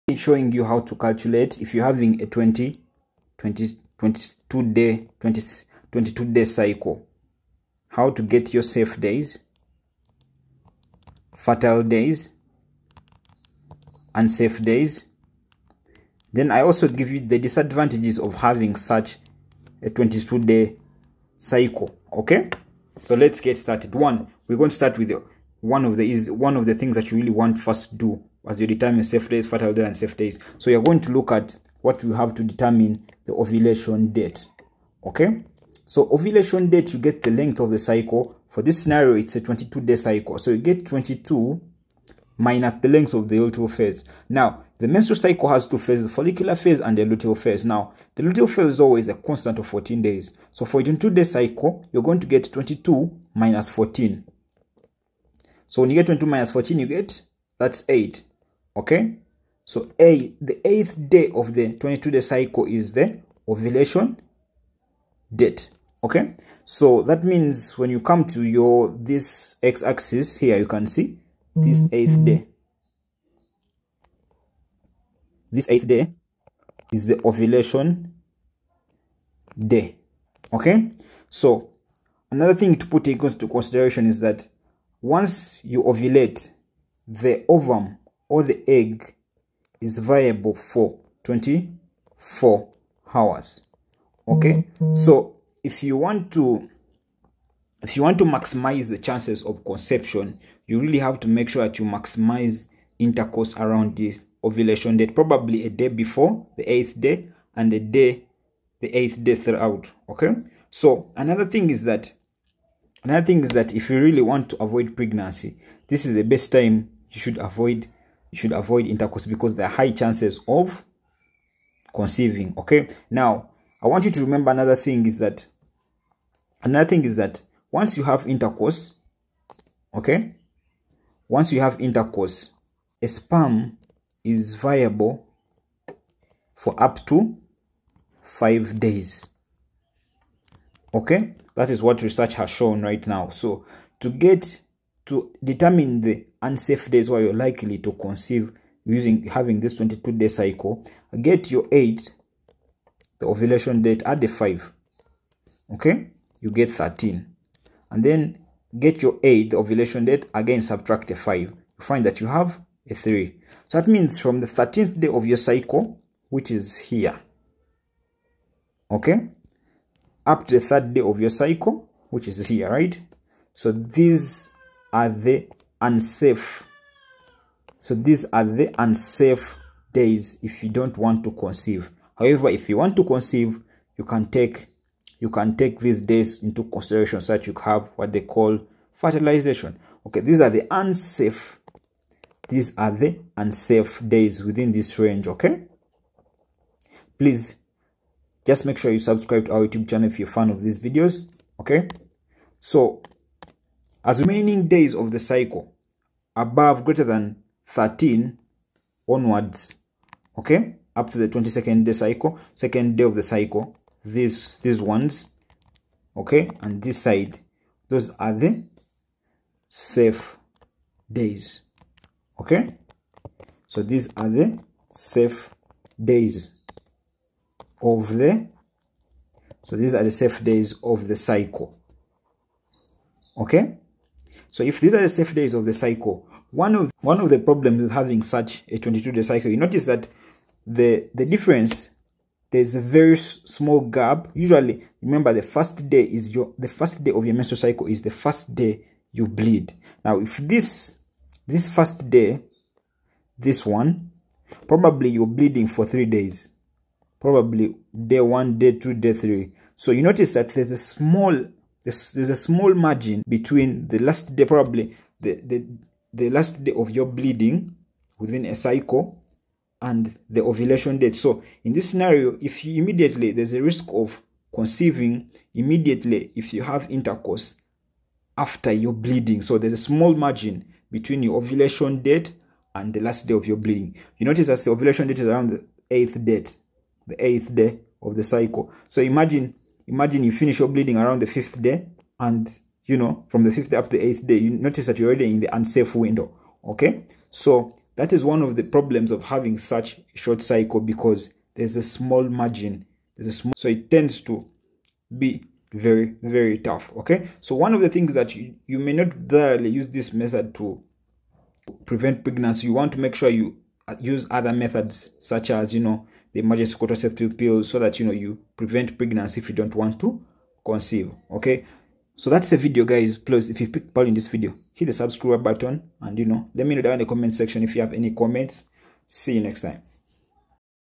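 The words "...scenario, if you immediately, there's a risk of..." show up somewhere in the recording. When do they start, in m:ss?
4:31.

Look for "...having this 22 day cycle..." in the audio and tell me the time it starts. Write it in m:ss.
2:29.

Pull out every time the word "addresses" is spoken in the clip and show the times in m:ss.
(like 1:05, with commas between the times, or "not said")
not said.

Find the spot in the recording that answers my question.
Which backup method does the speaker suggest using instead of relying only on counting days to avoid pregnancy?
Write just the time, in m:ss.
5:16.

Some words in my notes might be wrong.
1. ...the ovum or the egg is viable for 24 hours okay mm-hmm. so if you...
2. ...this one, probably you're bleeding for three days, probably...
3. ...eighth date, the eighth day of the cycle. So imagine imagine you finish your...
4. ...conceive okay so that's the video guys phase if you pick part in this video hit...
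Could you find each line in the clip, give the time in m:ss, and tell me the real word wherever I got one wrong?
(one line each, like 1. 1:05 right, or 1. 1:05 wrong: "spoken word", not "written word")
1. 1:27 right
2. 4:13 right
3. 4:45 right
4. 5:20 wrong: "please", not "phase".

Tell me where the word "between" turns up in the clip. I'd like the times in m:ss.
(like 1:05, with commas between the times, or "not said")
4:23, 4:40.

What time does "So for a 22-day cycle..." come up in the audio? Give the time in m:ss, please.
0:50.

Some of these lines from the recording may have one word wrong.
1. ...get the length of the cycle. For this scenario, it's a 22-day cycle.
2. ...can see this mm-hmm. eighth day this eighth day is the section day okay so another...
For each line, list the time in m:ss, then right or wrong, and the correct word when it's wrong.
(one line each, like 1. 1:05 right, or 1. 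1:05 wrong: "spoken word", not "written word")
1. 0:36 right
2. 1:10 wrong: "ovulation", not "section".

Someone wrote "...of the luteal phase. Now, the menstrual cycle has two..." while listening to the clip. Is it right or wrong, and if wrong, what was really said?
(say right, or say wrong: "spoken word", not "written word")
right.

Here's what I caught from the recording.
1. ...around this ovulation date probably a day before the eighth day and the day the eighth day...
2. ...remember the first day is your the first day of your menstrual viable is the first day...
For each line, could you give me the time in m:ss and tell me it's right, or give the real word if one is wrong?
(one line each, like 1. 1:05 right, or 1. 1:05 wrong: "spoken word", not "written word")
1. 1:43 right
2. 4:05 wrong: "cycle", not "viable".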